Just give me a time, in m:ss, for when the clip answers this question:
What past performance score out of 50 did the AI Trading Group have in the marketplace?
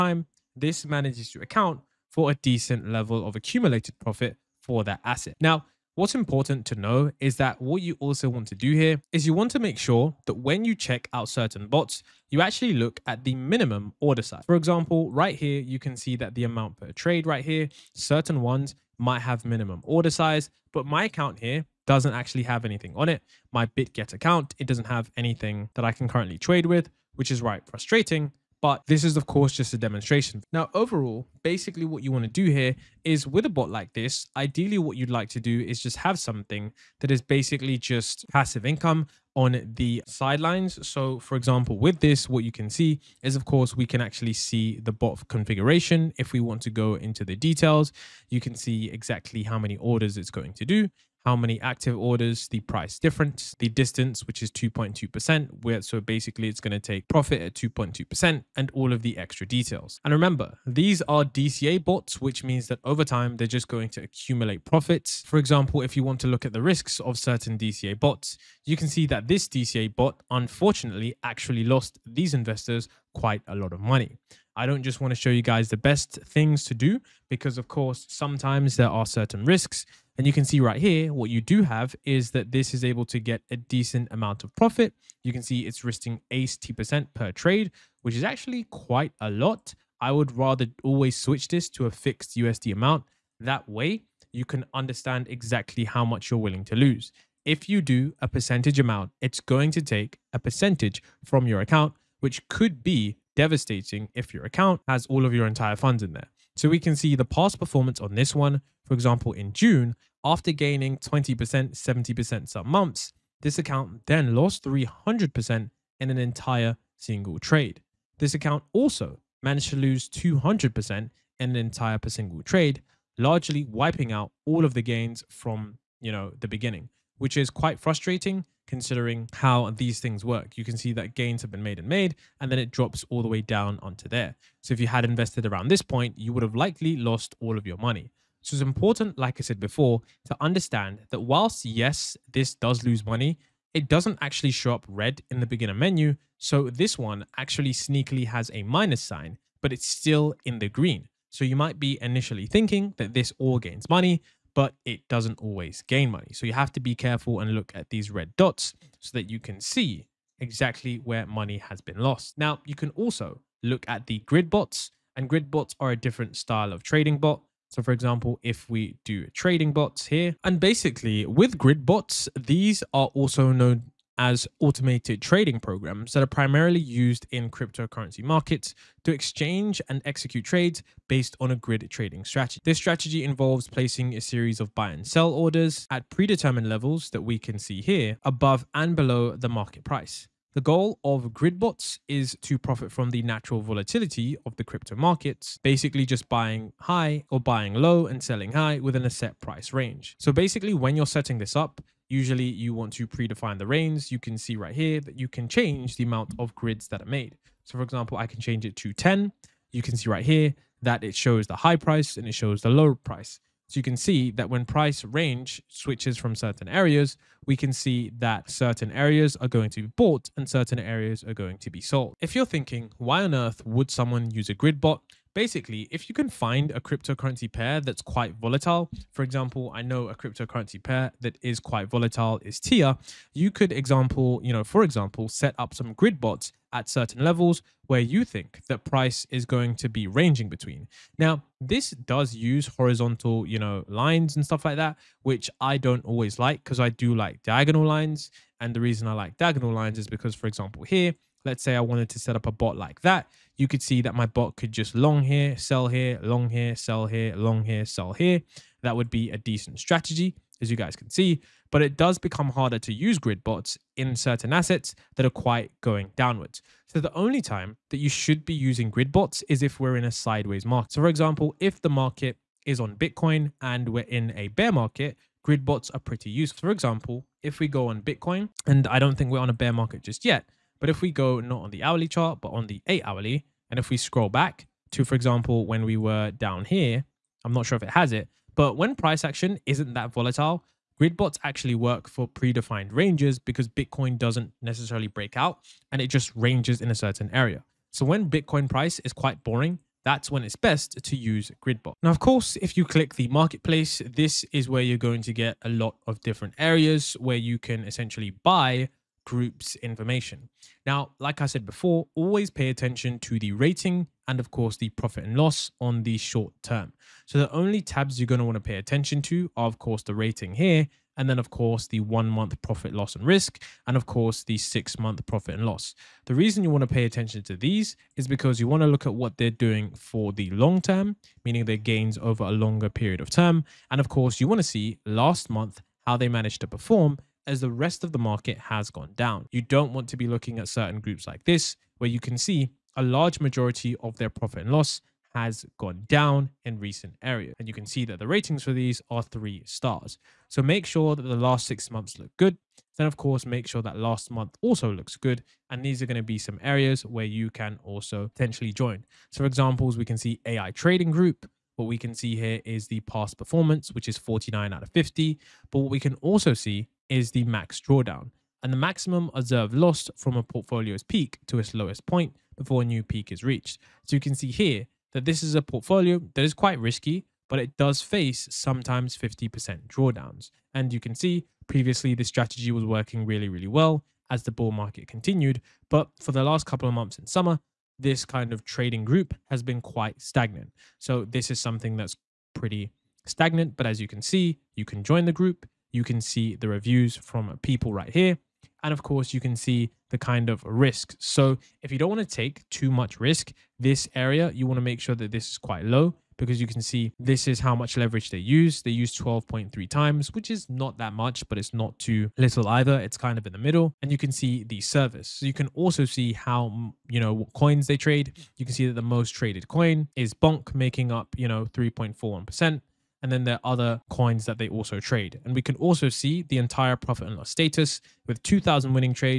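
6:04.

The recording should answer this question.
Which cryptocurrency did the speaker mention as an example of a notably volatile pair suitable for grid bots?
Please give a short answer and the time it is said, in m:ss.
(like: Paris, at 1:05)
TIA, at 3:52.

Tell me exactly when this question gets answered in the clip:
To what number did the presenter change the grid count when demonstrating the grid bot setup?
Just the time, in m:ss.
3:28.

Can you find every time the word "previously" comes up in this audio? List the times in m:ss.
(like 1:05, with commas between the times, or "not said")
6:21.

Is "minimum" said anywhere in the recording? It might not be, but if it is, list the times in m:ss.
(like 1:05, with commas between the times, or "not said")
0:13, 0:19.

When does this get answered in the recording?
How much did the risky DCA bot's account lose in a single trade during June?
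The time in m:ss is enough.
1:54.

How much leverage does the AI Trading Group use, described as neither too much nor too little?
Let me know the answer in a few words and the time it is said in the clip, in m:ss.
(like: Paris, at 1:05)
12.3 times, at 6:49.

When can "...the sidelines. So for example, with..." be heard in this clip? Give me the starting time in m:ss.
0:39.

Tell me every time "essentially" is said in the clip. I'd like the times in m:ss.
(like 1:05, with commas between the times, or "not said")
5:07.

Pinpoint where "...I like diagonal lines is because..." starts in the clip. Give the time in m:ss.
4:09.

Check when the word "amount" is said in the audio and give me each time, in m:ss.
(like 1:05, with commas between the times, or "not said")
0:16, 1:24, 1:32, 1:38, 3:26.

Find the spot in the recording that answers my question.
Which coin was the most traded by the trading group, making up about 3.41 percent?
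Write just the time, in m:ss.
7:00.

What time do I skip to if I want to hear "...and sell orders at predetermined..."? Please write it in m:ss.
3:04.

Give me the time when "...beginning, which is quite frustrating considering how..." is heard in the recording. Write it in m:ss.
2:06.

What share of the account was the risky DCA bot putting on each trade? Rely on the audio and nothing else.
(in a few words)
80%.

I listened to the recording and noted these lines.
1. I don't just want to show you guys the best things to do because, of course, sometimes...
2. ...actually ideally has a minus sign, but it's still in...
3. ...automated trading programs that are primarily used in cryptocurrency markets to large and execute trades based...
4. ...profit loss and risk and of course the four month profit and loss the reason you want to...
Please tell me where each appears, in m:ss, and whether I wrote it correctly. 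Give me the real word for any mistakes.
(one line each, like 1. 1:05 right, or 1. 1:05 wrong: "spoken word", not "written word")
1. 1:14 right
2. 2:27 wrong: "sneakily", not "ideally"
3. 2:54 wrong: "exchange", not "large"
4. 5:22 wrong: "six", not "four".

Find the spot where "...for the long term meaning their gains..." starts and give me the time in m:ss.
5:29.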